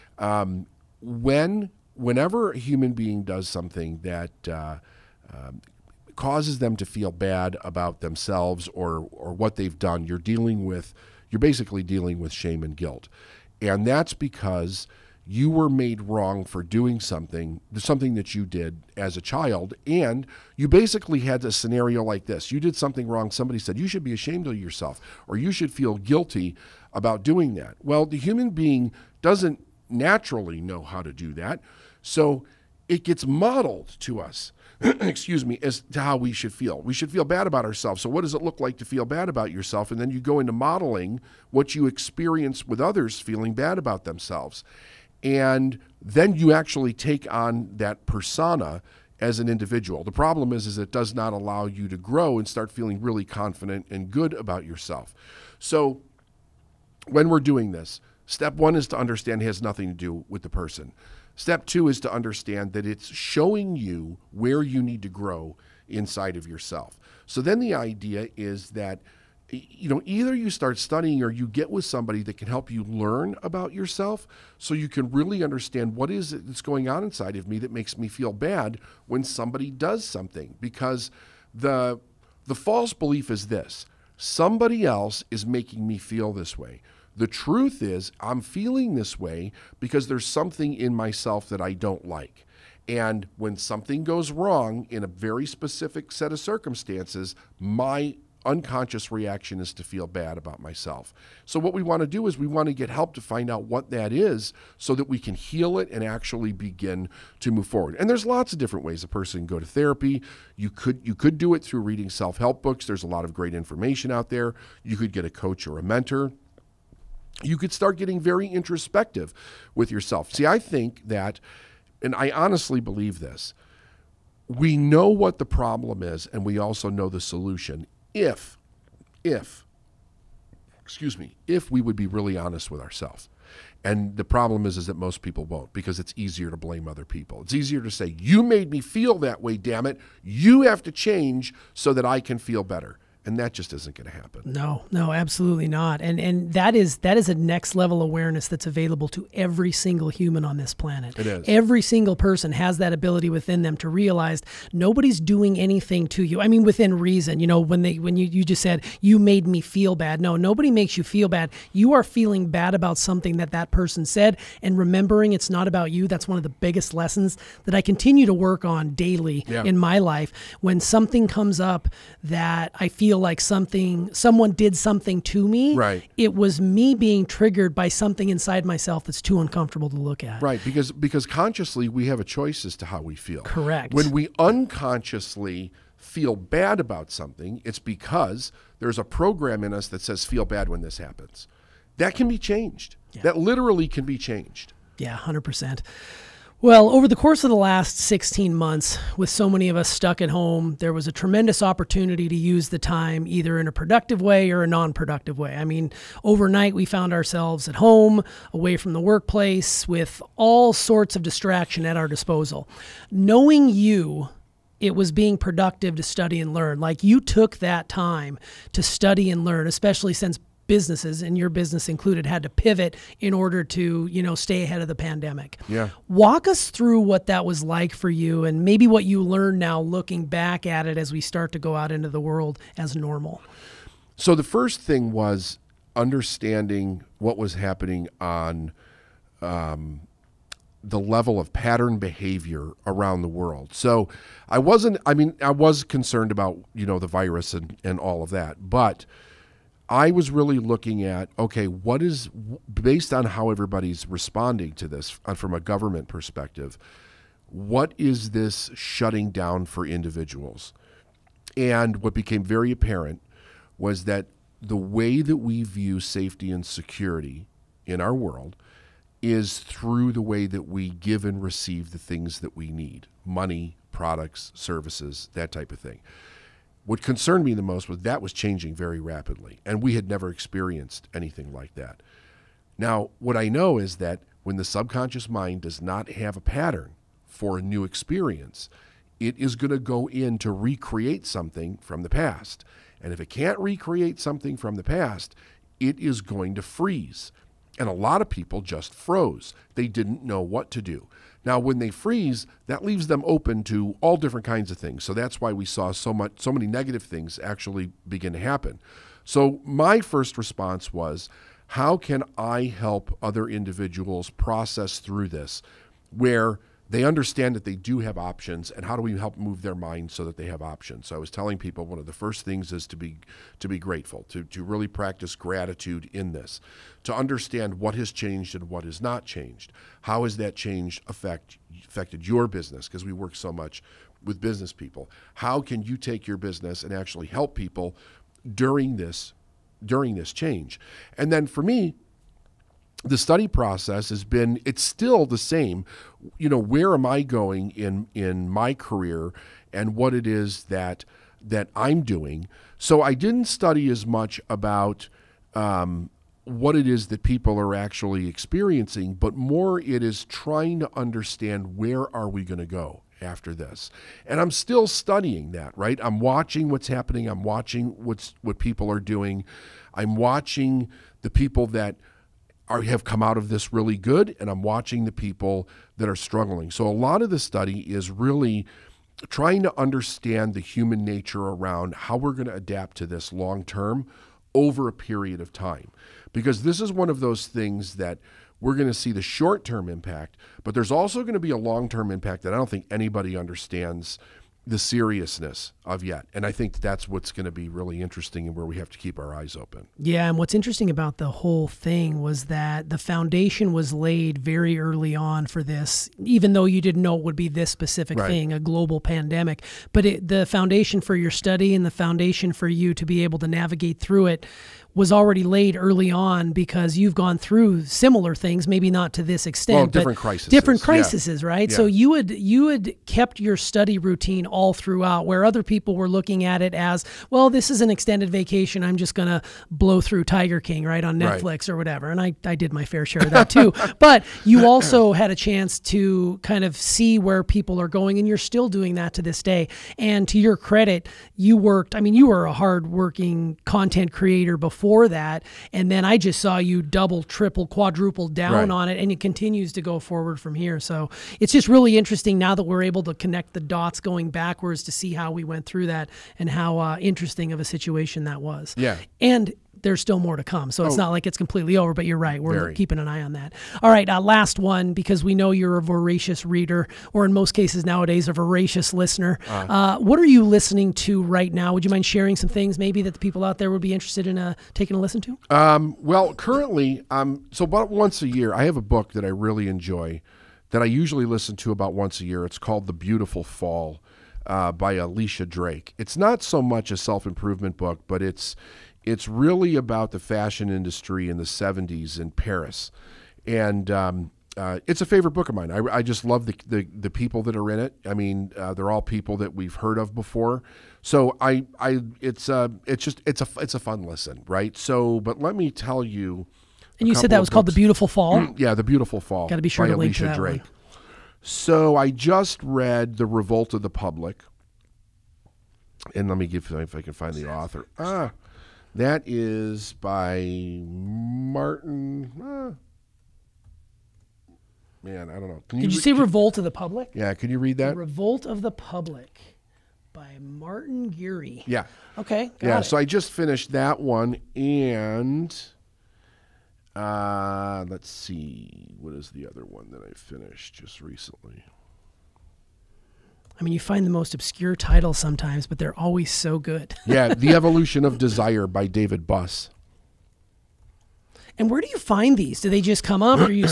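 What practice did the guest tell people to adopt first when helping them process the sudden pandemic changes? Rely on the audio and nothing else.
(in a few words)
gratitude.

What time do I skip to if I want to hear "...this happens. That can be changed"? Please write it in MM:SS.
03:10.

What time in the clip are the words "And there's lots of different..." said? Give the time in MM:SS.
01:47.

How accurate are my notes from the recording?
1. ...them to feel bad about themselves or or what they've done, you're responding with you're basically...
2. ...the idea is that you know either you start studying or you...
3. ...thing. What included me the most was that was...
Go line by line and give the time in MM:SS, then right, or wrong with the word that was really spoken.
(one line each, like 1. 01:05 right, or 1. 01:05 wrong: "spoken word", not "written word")
1. 00:06 wrong: "dealing", not "responding"
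2. 01:07 right
3. 04:35 wrong: "concerned", not "included".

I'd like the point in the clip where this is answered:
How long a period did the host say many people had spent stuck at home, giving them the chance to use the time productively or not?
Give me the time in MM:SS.
03:17.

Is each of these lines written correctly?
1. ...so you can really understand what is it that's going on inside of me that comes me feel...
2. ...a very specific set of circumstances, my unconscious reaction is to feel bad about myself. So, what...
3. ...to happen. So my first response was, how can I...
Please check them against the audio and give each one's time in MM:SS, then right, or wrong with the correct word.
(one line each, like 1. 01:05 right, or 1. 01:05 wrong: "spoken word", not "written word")
1. 01:14 wrong: "makes", not "comes"
2. 01:35 right
3. 05:08 right.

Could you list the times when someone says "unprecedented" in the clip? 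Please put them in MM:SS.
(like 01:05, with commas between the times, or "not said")
not said.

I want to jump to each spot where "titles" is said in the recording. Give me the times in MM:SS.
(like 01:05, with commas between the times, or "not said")
09:04.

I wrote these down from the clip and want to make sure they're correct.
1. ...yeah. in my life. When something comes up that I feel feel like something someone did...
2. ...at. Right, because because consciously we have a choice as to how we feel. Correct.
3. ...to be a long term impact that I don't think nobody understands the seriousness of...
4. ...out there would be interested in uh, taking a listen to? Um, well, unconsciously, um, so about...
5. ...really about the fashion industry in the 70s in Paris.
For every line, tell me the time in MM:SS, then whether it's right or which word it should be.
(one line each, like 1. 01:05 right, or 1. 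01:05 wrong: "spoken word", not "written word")
1. 02:49 right
2. 03:00 right
3. 06:31 wrong: "anybody", not "nobody"
4. 07:53 wrong: "currently", not "unconsciously"
5. 08:09 right.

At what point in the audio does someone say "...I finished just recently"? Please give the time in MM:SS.
09:00.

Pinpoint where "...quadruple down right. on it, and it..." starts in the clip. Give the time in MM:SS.
07:27.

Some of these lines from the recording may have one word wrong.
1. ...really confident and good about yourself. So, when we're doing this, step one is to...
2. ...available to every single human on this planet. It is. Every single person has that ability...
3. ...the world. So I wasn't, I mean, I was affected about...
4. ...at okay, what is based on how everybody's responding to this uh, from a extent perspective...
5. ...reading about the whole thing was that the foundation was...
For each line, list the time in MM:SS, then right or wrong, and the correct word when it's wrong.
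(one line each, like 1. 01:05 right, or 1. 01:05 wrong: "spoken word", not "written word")
1. 00:52 right
2. 02:28 right
3. 04:03 wrong: "concerned", not "affected"
4. 04:11 wrong: "government", not "extent"
5. 06:40 wrong: "interesting", not "reading".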